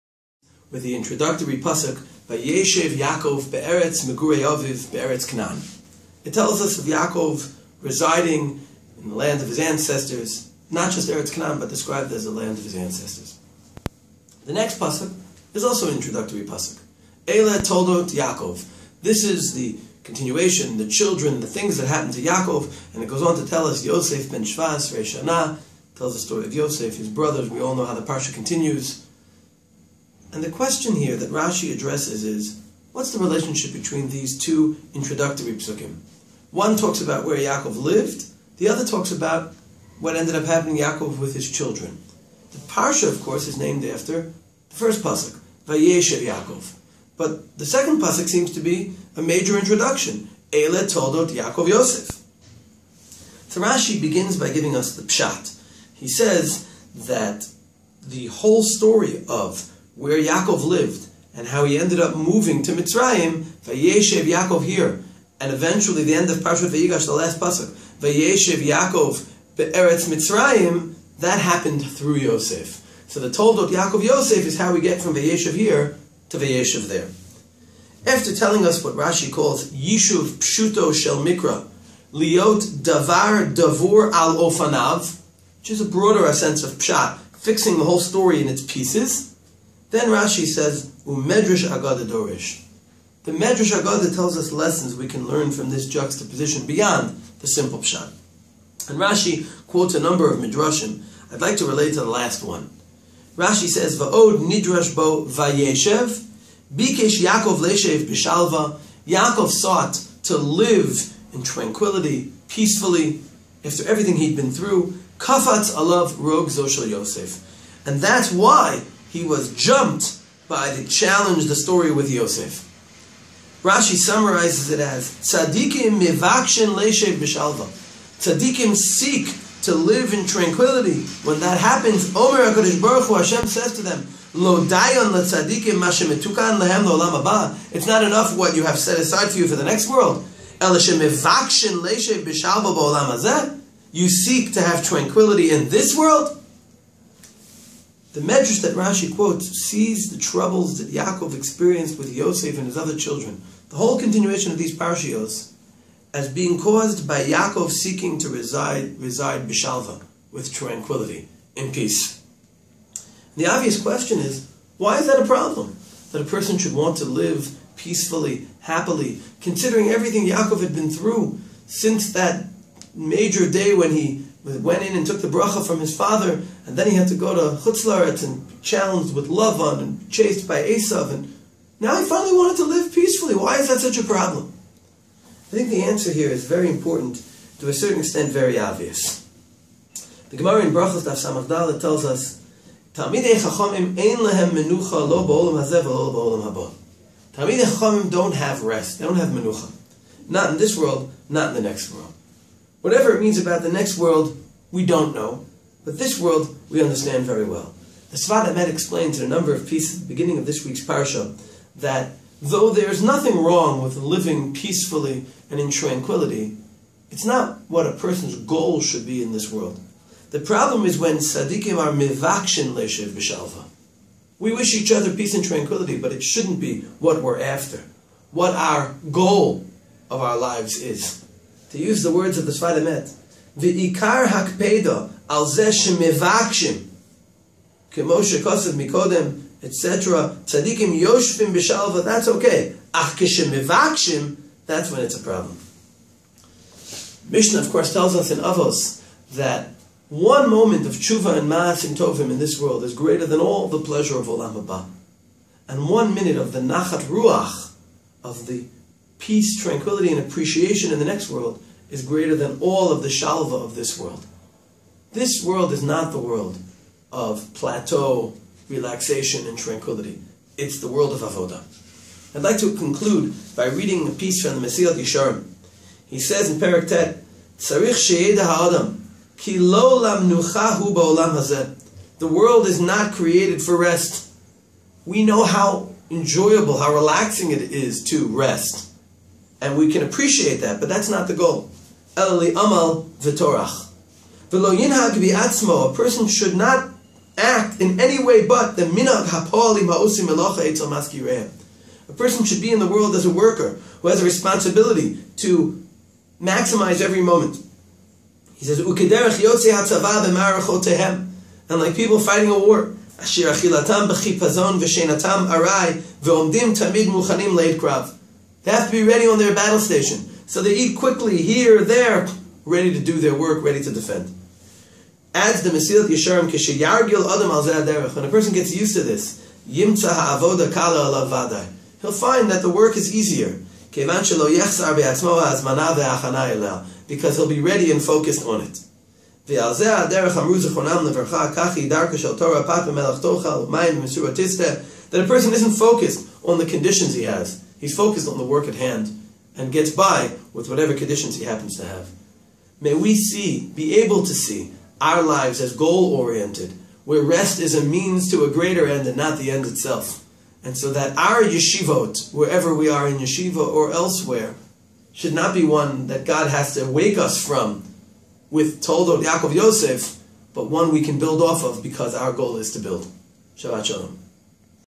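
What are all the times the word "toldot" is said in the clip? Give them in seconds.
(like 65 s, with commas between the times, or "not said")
17 s, 50 s, 73 s, 368 s.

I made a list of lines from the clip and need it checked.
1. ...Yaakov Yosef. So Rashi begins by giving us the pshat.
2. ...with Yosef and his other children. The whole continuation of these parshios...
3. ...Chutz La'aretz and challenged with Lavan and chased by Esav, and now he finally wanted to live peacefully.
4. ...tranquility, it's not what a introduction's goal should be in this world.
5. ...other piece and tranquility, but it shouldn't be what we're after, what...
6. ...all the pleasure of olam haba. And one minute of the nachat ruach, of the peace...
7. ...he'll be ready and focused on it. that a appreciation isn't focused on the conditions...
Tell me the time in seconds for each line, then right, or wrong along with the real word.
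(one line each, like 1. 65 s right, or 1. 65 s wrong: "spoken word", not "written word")
1. 51 s right
2. 151 s right
3. 177 s right
4. 215 s wrong: "person", not "introduction"
5. 224 s wrong: "peace", not "piece"
6. 253 s right
7. 337 s wrong: "person", not "appreciation".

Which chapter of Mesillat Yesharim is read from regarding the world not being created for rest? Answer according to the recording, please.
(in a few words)
Perek Tet.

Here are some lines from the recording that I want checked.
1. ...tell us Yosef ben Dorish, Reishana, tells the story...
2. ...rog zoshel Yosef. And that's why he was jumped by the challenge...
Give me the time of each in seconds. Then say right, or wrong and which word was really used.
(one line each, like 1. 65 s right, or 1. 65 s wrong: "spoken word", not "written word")
1. 23 s wrong: "Shvas", not "Dorish"
2. 116 s right.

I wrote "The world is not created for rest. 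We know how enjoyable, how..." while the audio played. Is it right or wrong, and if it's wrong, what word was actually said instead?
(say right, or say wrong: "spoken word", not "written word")
right.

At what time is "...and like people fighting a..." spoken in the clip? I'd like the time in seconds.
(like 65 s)
311 s.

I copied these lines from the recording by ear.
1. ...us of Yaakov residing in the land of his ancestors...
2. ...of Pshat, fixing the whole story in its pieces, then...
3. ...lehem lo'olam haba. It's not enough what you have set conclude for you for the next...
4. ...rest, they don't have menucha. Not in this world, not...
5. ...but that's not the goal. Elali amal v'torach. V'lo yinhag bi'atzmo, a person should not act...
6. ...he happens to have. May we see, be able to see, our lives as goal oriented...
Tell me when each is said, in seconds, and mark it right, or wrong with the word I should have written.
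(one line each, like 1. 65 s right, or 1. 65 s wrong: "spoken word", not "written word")
1. 6 s right
2. 86 s right
3. 136 s wrong: "aside", not "conclude"
4. 198 s right
5. 290 s right
6. 351 s right.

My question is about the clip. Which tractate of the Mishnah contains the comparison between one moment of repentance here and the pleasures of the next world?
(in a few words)
Avos.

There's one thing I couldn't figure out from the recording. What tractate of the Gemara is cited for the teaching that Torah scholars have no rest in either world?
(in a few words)
Brachos.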